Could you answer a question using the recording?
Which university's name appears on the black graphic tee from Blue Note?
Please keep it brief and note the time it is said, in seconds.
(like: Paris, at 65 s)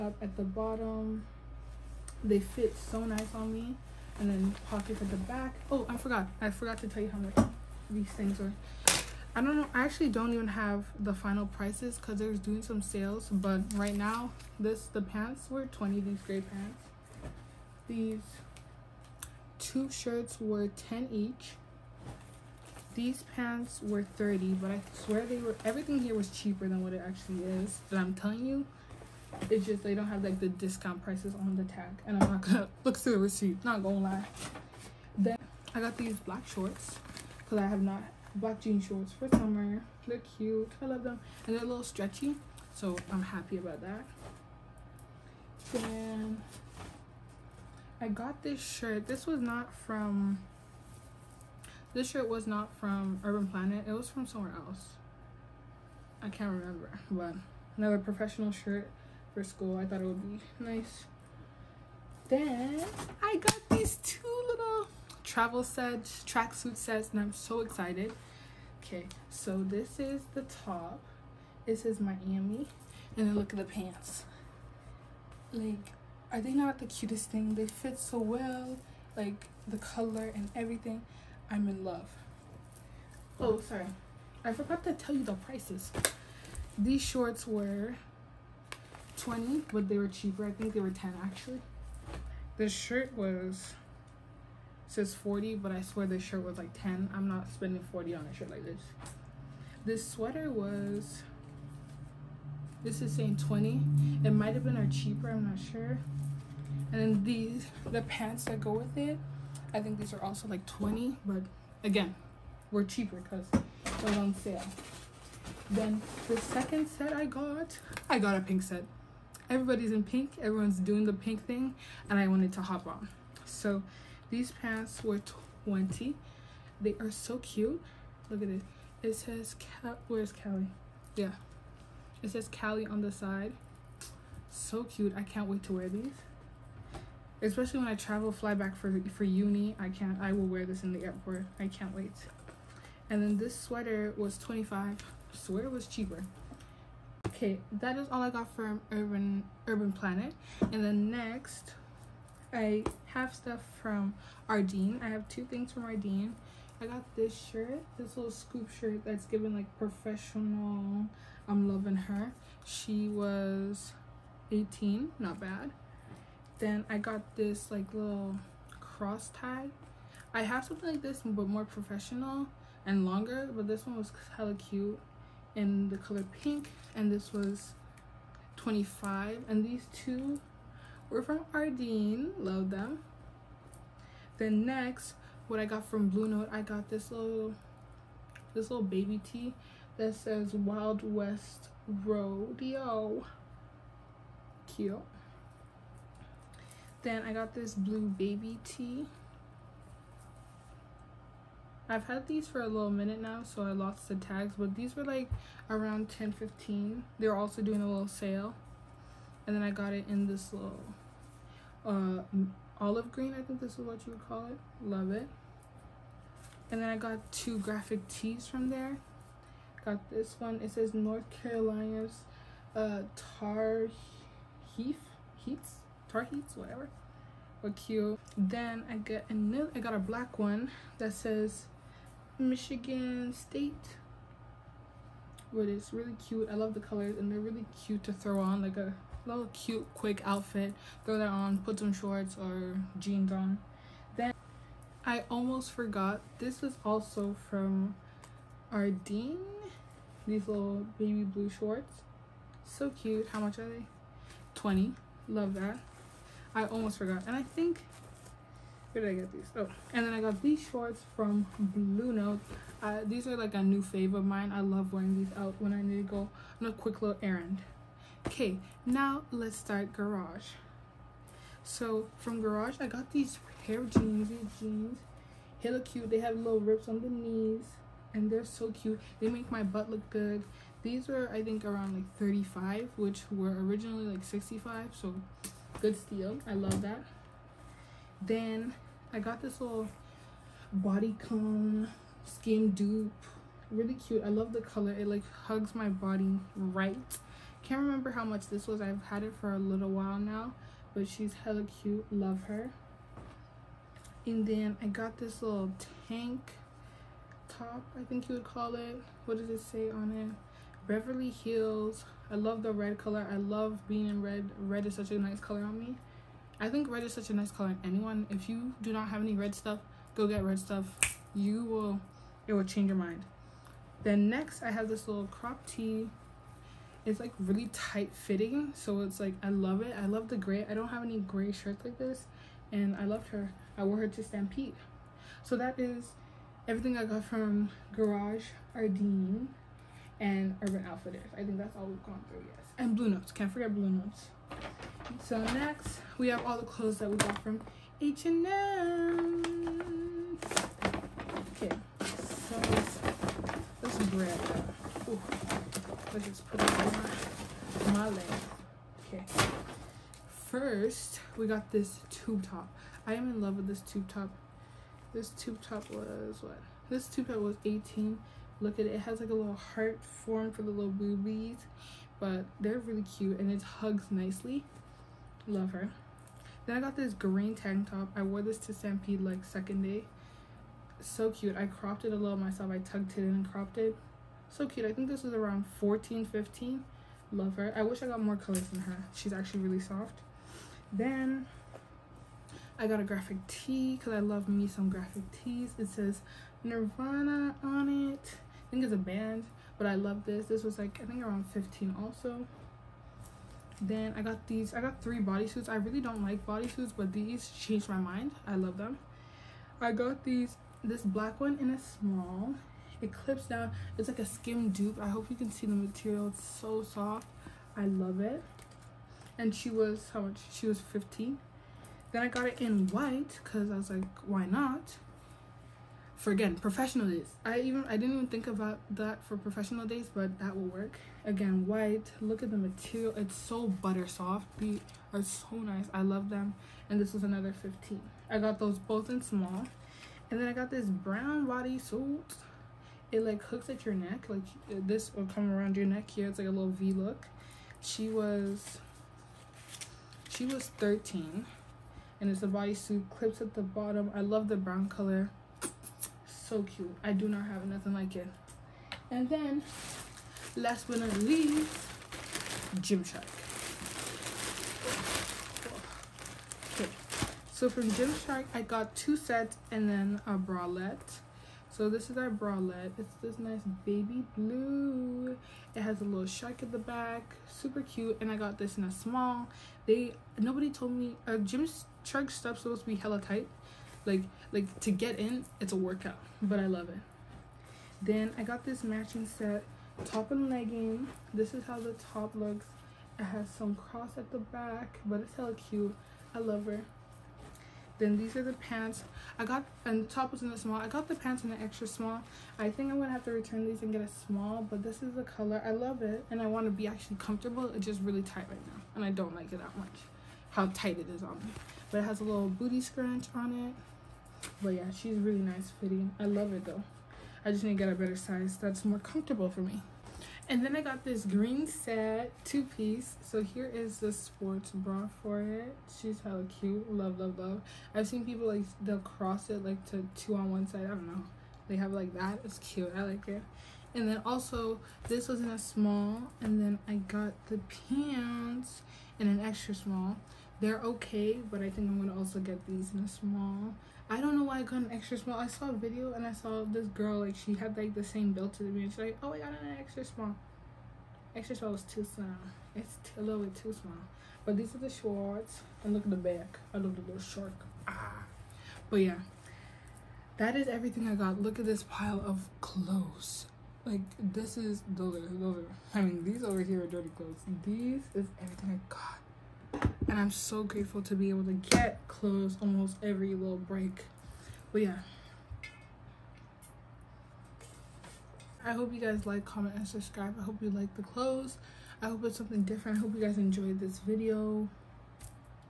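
Michigan State, at 232 s.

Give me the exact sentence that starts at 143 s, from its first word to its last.
And then this sweater was twenty five.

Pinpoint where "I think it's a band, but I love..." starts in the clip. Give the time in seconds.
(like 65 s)
398 s.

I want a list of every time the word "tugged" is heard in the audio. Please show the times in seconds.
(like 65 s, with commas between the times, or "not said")
382 s.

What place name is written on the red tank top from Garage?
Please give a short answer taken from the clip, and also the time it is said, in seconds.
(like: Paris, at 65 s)
Beverly Hills, at 310 s.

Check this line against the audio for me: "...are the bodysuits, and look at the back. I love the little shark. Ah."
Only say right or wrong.
wrong.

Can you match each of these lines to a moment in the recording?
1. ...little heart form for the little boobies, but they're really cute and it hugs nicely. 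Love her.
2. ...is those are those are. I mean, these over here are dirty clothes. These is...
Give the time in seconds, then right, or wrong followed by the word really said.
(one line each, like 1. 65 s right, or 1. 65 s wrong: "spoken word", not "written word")
1. 369 s right
2. 564 s right.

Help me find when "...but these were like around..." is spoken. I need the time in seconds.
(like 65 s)
204 s.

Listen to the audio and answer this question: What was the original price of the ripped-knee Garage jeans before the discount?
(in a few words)
65.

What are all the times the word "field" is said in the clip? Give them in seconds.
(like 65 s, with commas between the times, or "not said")
not said.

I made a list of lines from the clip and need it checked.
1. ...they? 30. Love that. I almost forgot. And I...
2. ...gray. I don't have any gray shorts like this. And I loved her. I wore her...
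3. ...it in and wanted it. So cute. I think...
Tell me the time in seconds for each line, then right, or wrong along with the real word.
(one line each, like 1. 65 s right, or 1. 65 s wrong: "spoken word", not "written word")
1. 253 s wrong: "20", not "30"
2. 330 s wrong: "shirts", not "shorts"
3. 383 s wrong: "cropped", not "wanted".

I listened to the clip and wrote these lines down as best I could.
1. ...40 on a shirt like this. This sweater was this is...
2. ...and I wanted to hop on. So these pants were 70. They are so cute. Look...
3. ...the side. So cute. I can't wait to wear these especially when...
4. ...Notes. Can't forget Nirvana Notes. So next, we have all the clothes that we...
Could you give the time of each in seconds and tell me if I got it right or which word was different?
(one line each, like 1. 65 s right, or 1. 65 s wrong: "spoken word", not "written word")
1. 97 s right
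2. 122 s wrong: "20", not "70"
3. 133 s right
4. 343 s wrong: "Blue", not "Nirvana".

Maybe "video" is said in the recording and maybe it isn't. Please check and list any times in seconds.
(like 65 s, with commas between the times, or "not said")
545 s, 583 s.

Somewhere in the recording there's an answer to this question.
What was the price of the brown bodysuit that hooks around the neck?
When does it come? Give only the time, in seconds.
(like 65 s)
450 s.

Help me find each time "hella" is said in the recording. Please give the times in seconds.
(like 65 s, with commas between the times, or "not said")
174 s, 301 s, 482 s, 495 s, 526 s.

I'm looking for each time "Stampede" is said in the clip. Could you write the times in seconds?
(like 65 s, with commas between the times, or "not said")
334 s, 378 s.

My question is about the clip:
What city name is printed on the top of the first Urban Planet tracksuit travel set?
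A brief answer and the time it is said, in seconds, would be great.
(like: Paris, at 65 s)
Miami, at 71 s.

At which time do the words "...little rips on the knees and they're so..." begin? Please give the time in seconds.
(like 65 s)
276 s.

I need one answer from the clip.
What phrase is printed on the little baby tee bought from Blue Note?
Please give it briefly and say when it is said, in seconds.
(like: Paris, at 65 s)
Wild West Rodeo, at 190 s.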